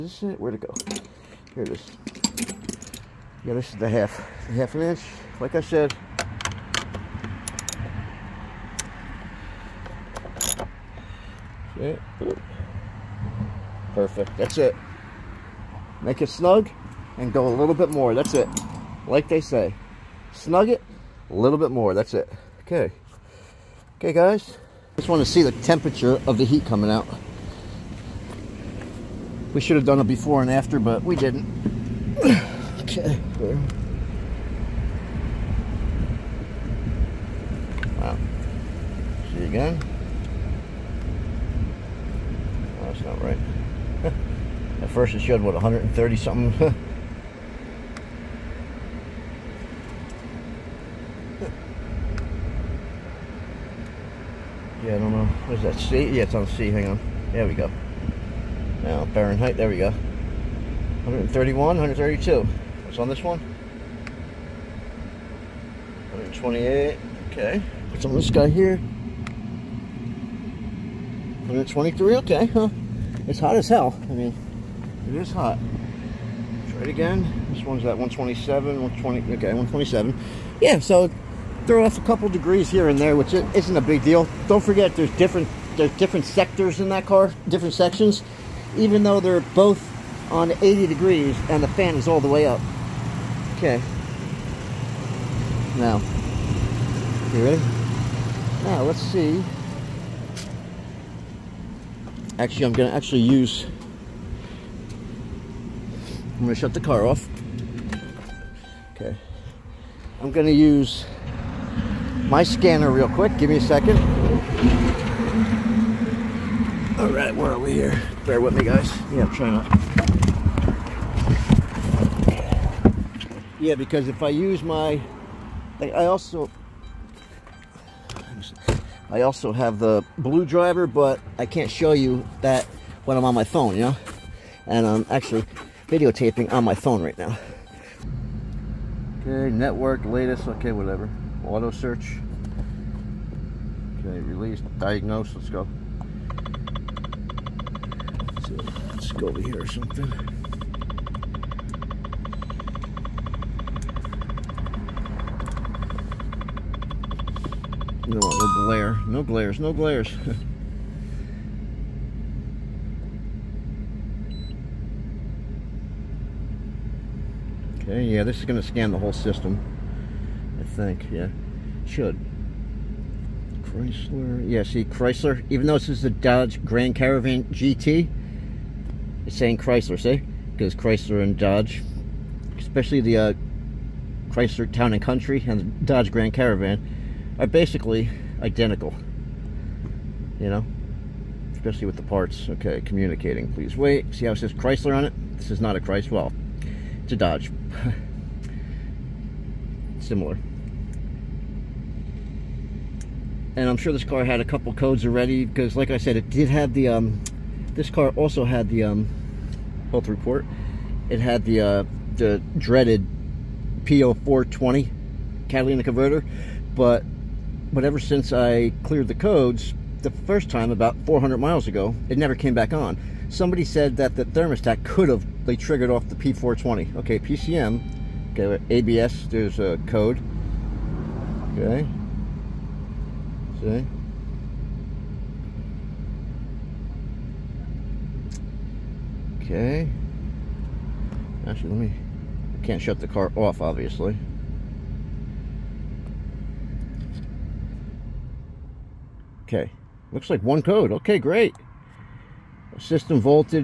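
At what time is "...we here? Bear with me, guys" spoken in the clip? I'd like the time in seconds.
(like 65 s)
117 s.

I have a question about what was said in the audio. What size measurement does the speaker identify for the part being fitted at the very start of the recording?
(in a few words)
half an inch.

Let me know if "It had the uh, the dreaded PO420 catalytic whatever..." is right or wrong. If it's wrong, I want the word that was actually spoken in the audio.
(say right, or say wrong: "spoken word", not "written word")
wrong: "converter", not "whatever".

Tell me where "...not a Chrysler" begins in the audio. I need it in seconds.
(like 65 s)
195 s.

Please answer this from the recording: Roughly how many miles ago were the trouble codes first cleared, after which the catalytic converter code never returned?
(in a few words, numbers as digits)
400 miles.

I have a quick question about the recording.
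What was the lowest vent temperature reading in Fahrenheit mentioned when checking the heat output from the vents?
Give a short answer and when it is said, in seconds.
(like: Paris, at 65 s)
123, at 71 s.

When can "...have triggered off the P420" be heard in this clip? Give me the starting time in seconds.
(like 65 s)
225 s.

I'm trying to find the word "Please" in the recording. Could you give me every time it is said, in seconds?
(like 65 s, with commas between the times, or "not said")
193 s.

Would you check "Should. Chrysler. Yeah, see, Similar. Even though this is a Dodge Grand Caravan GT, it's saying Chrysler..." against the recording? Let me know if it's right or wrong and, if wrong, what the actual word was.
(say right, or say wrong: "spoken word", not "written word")
wrong: "Chrysler", not "Similar".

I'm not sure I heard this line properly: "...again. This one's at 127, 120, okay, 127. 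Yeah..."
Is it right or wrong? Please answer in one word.
right.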